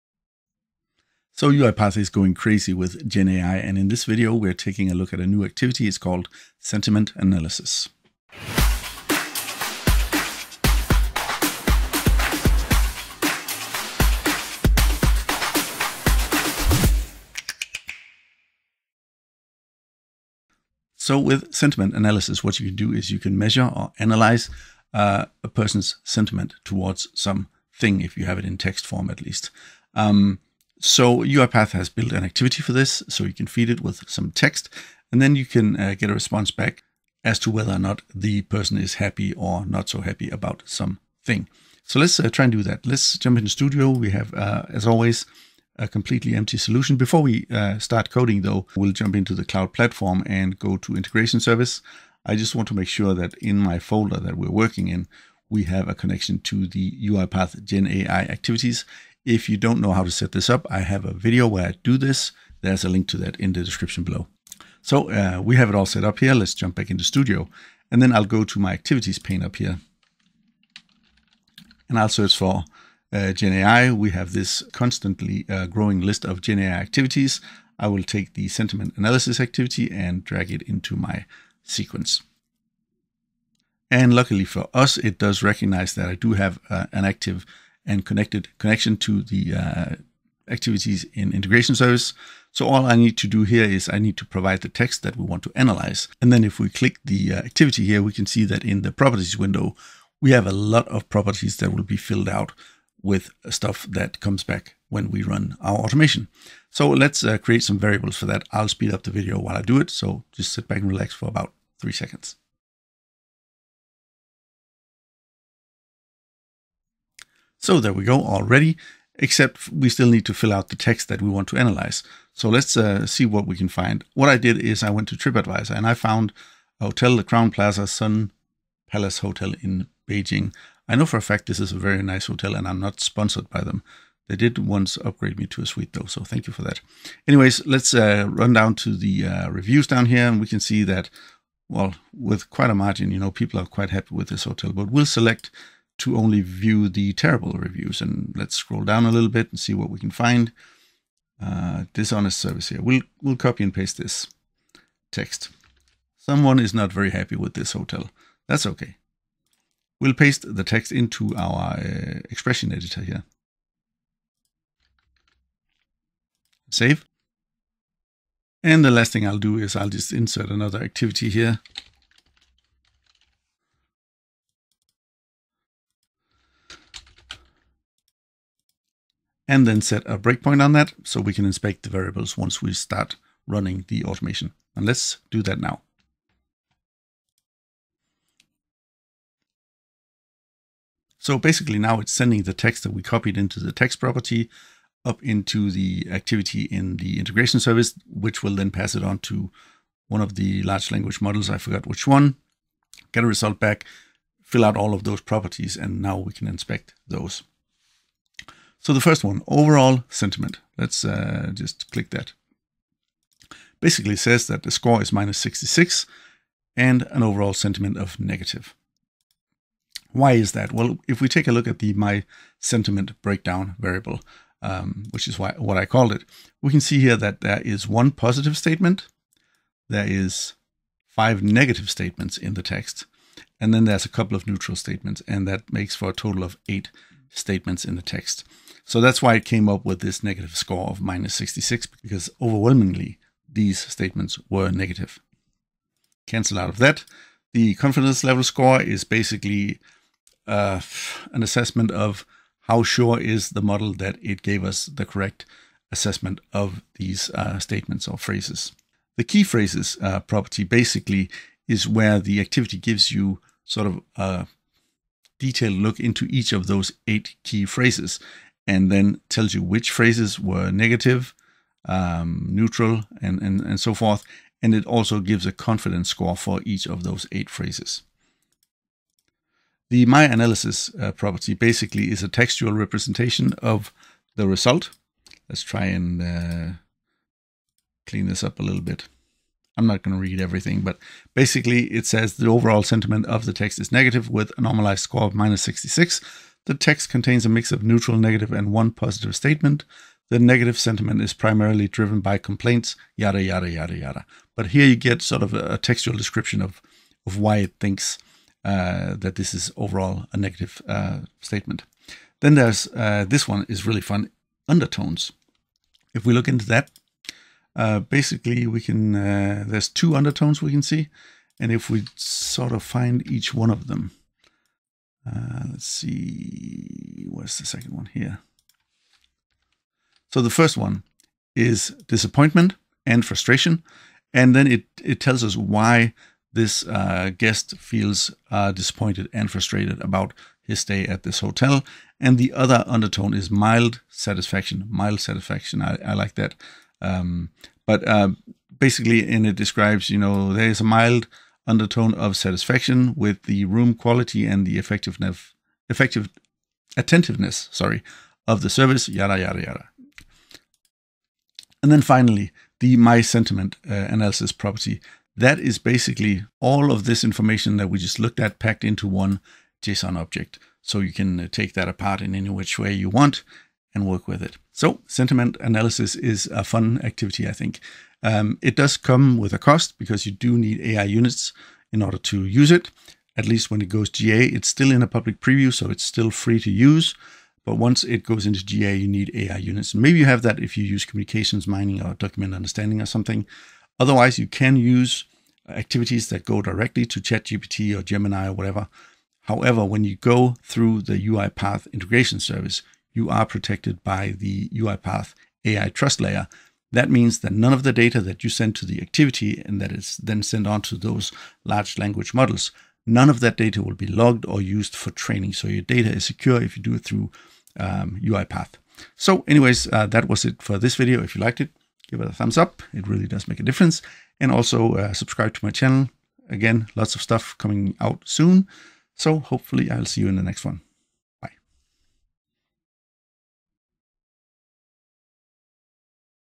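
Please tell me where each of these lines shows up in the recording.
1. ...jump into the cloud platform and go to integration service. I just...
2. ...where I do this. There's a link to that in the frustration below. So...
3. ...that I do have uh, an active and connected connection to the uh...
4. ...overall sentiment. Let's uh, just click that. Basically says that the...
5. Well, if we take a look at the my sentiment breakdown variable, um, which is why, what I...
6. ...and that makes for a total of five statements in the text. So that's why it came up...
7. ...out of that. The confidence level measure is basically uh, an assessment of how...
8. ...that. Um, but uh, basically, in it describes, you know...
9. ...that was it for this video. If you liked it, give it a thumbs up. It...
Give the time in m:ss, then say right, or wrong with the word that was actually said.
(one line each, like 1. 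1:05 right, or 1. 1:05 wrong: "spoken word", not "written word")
1. 0:48 right
2. 1:01 wrong: "description", not "frustration"
3. 1:25 right
4. 3:29 right
5. 3:40 right
6. 3:55 wrong: "eight", not "five"
7. 4:06 wrong: "score", not "measure"
8. 5:46 right
9. 7:00 right.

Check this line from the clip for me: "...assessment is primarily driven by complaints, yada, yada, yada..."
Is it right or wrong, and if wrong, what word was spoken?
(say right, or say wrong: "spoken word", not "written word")
wrong: "sentiment", not "assessment".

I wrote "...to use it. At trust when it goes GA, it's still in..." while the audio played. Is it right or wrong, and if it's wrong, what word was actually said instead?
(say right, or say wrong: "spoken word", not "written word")
wrong: "least", not "trust".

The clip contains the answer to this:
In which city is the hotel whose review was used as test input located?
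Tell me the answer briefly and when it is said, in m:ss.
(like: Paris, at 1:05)
Beijing, at 2:10.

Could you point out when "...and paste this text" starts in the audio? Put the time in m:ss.
2:33.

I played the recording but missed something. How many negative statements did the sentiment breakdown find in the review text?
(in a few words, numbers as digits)
5.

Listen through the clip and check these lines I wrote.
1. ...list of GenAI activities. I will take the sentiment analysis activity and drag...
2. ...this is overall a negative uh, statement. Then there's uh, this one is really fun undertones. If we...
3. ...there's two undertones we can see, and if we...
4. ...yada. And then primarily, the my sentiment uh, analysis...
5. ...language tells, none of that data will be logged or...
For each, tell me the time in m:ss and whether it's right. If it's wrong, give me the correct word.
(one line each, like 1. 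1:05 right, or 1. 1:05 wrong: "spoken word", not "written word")
1. 1:16 right
2. 5:09 right
3. 5:19 right
4. 5:59 wrong: "finally", not "primarily"
5. 6:51 wrong: "models", not "tells".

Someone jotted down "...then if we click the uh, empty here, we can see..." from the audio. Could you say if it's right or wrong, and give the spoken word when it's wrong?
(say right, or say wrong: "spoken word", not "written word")
wrong: "activity", not "empty".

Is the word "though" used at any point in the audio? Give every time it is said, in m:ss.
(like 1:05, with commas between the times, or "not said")
0:48, 2:15.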